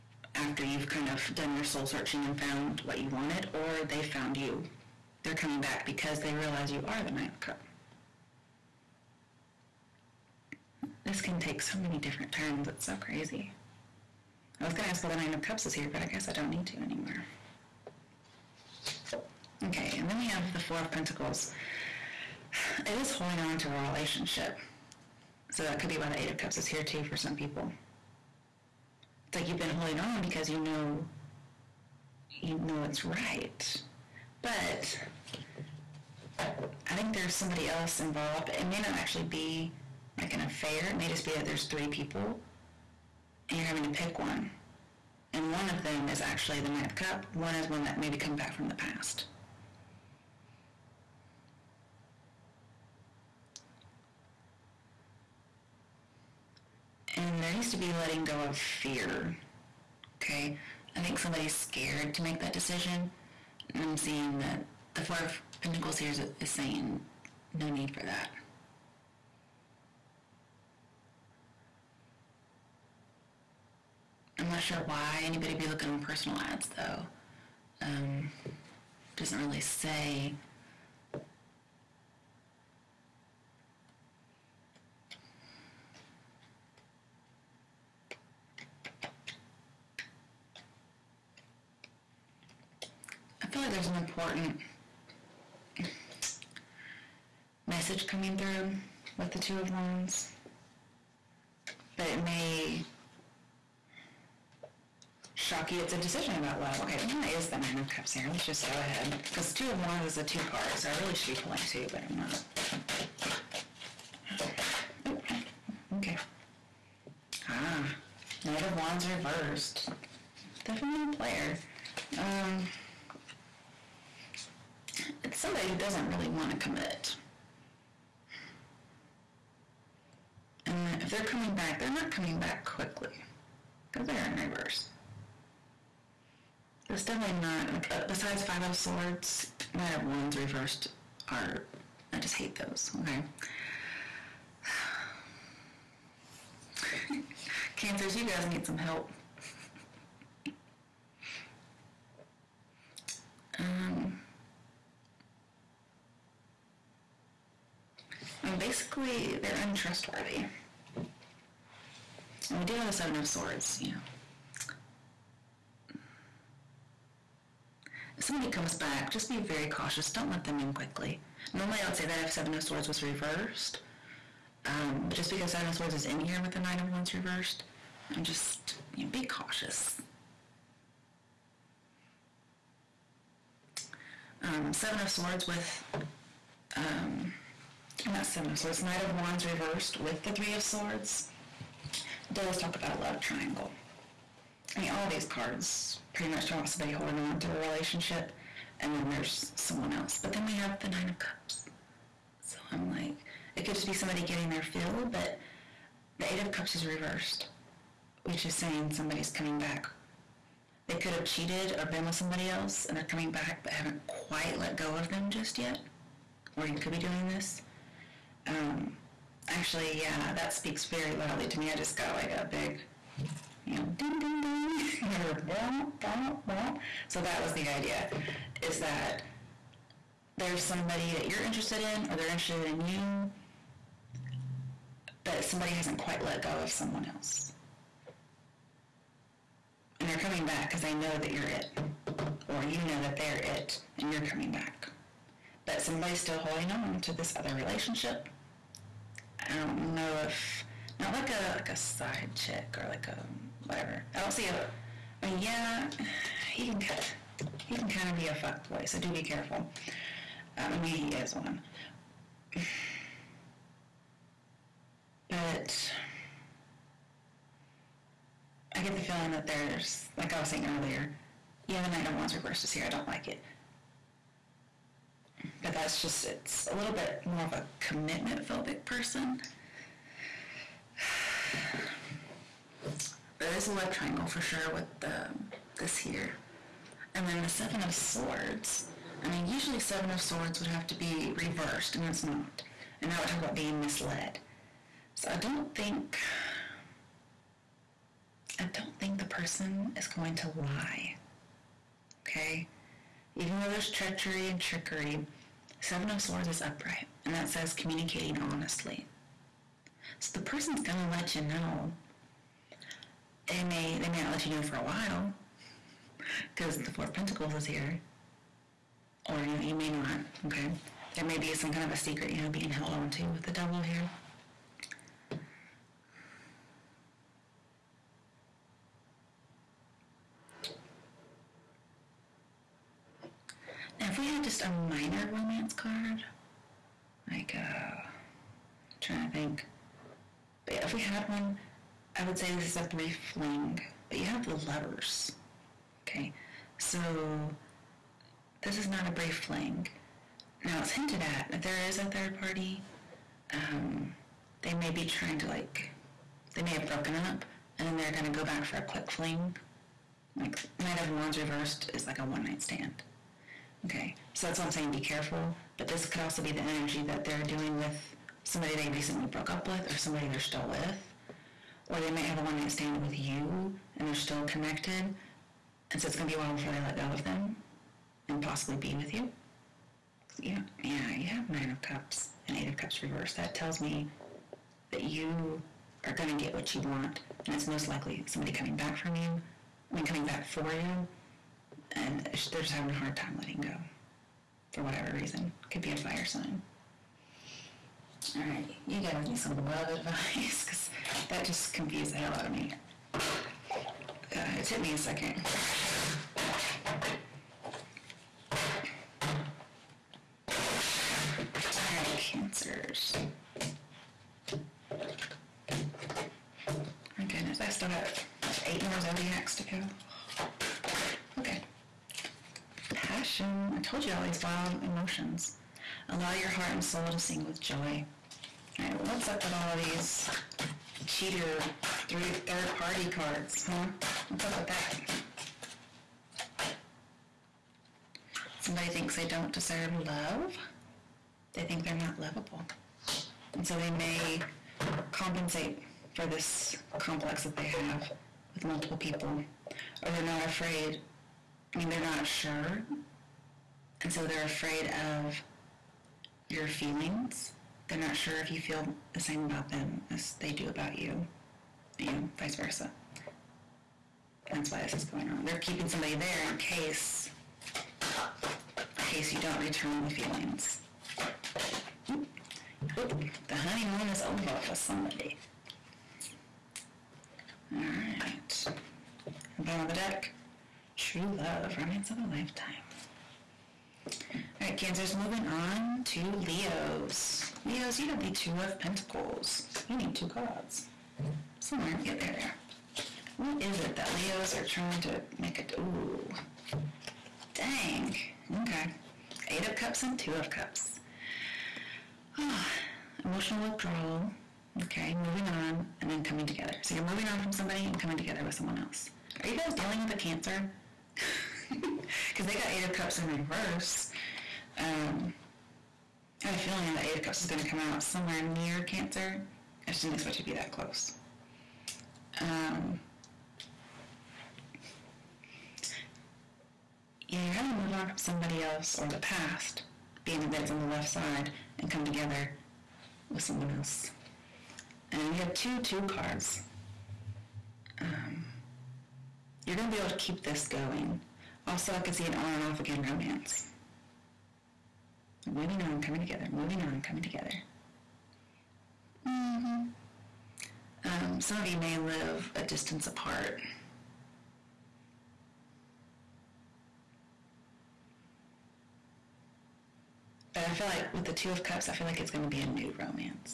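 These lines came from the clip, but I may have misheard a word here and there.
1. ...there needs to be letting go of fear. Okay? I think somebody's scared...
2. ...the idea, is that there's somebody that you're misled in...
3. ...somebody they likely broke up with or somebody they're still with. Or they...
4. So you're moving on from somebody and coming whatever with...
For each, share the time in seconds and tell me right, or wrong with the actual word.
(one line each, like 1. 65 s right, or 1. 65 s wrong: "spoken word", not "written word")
1. 57 s right
2. 227 s wrong: "interested", not "misled"
3. 368 s wrong: "recently", not "likely"
4. 506 s wrong: "together", not "whatever".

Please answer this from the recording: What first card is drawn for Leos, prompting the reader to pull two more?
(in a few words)
Two of Pentacles.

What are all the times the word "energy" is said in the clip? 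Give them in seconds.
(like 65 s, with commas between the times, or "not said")
366 s.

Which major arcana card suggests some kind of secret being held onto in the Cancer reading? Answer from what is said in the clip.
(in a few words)
The Devil.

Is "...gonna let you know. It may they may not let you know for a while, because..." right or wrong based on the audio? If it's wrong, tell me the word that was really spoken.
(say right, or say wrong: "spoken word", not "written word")
right.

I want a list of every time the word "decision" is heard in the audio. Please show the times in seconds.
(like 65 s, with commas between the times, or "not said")
62 s, 105 s.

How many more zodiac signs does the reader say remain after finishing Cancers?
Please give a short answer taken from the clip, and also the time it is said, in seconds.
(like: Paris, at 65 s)
8, at 418 s.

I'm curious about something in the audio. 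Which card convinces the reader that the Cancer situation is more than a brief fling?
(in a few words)
The Lovers.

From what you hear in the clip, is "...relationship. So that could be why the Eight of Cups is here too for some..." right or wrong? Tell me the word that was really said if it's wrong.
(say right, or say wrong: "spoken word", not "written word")
right.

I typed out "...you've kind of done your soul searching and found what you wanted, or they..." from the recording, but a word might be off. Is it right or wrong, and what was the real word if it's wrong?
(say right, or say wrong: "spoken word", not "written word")
right.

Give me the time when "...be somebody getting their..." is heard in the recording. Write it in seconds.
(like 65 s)
203 s.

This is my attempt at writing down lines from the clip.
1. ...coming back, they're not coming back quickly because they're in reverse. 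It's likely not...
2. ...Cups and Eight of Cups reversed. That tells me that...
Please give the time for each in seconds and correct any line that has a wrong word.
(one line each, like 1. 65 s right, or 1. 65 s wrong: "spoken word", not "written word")
1. 131 s wrong: "definitely", not "likely"
2. 381 s right.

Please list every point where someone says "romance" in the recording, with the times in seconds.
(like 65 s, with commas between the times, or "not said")
335 s, 481 s, 543 s, 562 s.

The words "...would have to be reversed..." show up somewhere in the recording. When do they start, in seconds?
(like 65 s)
290 s.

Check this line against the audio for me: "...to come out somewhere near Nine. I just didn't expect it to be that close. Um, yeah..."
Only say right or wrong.
wrong.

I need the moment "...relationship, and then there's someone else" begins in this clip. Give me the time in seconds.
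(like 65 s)
197 s.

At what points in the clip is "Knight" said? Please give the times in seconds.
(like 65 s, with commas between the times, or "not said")
118 s, 139 s, 176 s, 188 s, 271 s, 360 s.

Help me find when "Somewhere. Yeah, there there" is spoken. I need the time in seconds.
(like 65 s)
491 s.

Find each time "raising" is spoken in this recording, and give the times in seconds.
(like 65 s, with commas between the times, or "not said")
not said.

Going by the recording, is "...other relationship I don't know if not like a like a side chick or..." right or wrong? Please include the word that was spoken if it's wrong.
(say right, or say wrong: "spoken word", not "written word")
right.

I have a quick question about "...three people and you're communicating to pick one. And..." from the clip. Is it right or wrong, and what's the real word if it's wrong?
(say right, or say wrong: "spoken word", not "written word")
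wrong: "having", not "communicating".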